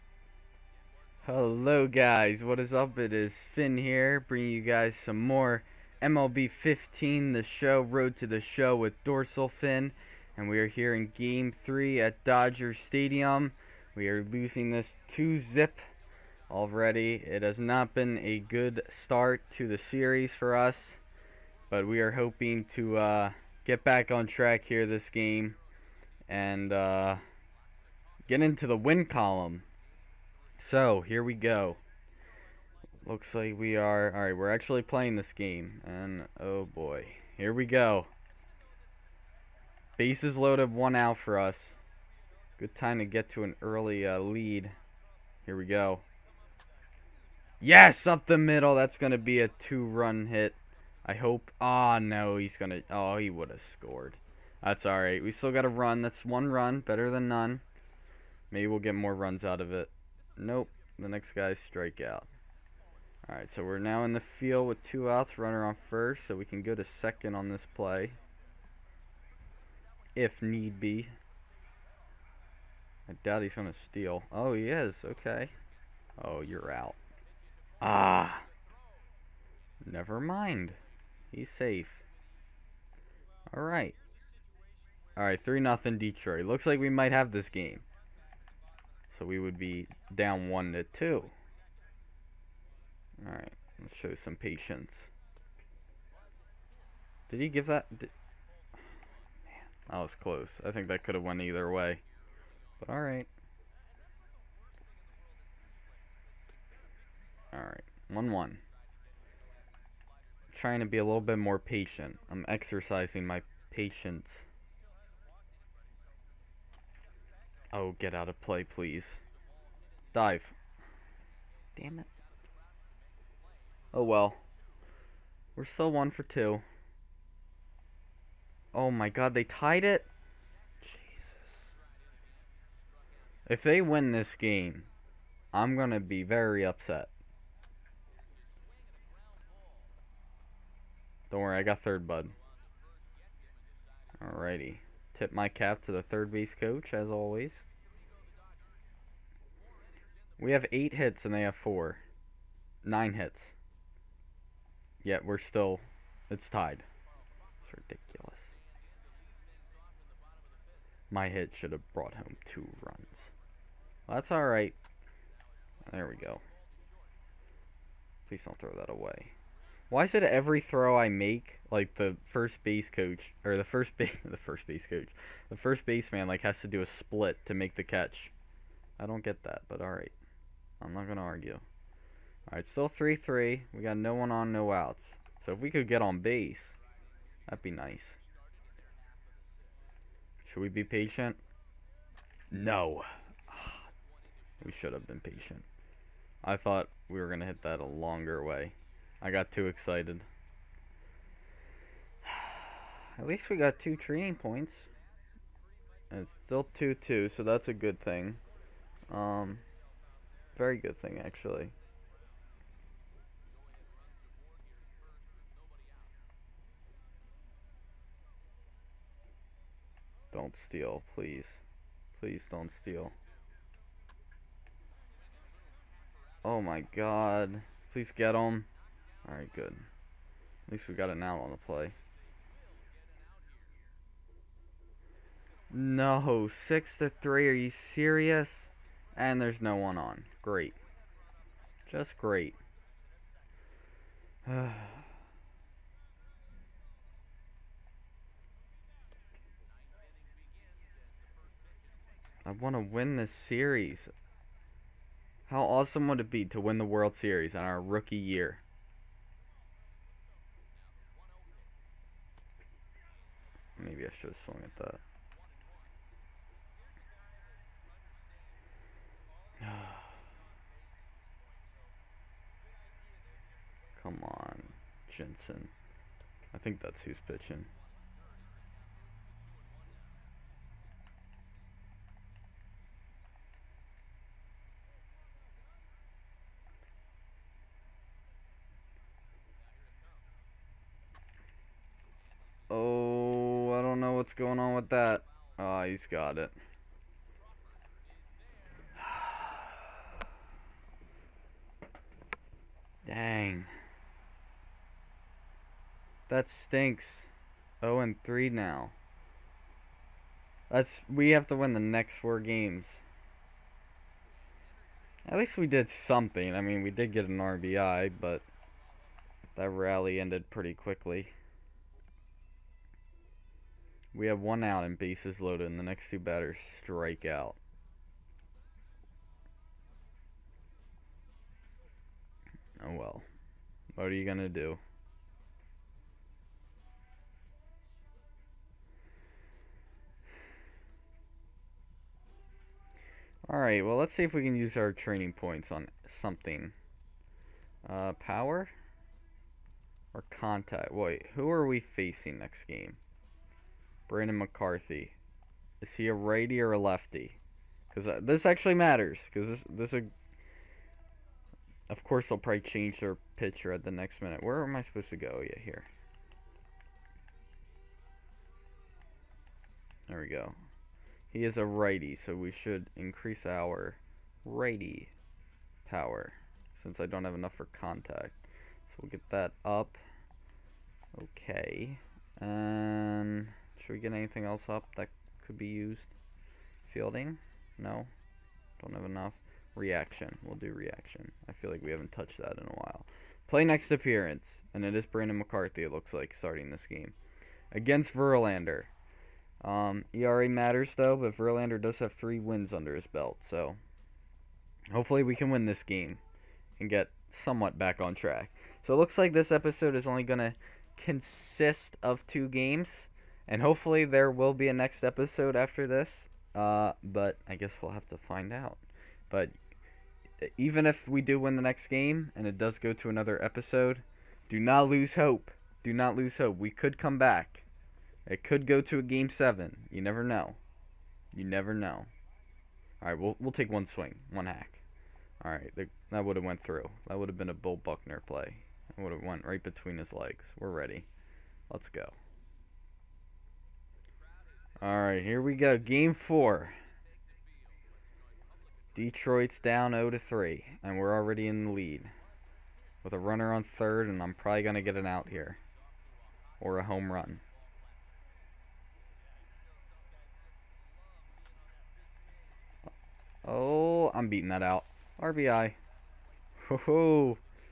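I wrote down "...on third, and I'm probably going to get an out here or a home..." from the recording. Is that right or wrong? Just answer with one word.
right.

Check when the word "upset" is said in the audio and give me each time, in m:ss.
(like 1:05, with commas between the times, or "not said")
2:16.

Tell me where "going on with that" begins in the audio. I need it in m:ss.
4:54.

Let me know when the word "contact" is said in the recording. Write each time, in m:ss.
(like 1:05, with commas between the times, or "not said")
5:50, 6:17.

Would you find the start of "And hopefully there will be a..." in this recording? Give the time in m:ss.
6:53.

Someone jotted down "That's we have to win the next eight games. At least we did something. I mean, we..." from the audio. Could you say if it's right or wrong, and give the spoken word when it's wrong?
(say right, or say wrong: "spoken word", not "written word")
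wrong: "four", not "eight".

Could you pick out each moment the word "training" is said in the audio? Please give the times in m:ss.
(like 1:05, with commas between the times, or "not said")
3:23, 5:44.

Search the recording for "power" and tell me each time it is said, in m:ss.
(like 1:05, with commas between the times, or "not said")
5:48, 6:15.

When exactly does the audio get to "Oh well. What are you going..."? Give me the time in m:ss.
5:32.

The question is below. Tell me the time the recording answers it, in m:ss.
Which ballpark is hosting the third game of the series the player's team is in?
0:12.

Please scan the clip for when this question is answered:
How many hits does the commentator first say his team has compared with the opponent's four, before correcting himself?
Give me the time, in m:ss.
2:30.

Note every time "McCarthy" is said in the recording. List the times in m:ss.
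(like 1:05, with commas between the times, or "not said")
5:54, 6:35.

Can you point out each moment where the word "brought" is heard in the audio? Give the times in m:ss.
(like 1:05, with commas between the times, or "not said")
2:41.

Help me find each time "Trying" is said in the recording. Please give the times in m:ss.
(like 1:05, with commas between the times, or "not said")
1:50.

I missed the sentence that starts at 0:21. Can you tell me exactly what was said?
But we are hoping to uh, get back on track here this game.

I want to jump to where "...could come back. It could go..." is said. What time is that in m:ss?
7:06.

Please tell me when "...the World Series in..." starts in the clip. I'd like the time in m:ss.
4:16.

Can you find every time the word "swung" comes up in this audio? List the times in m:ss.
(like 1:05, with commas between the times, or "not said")
4:24.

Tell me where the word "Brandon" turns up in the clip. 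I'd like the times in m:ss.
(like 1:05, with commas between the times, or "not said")
5:54, 6:35.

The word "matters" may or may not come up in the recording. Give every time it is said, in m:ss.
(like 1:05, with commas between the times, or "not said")
5:58, 6:40.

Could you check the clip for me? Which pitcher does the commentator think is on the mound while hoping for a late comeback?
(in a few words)
Jansen.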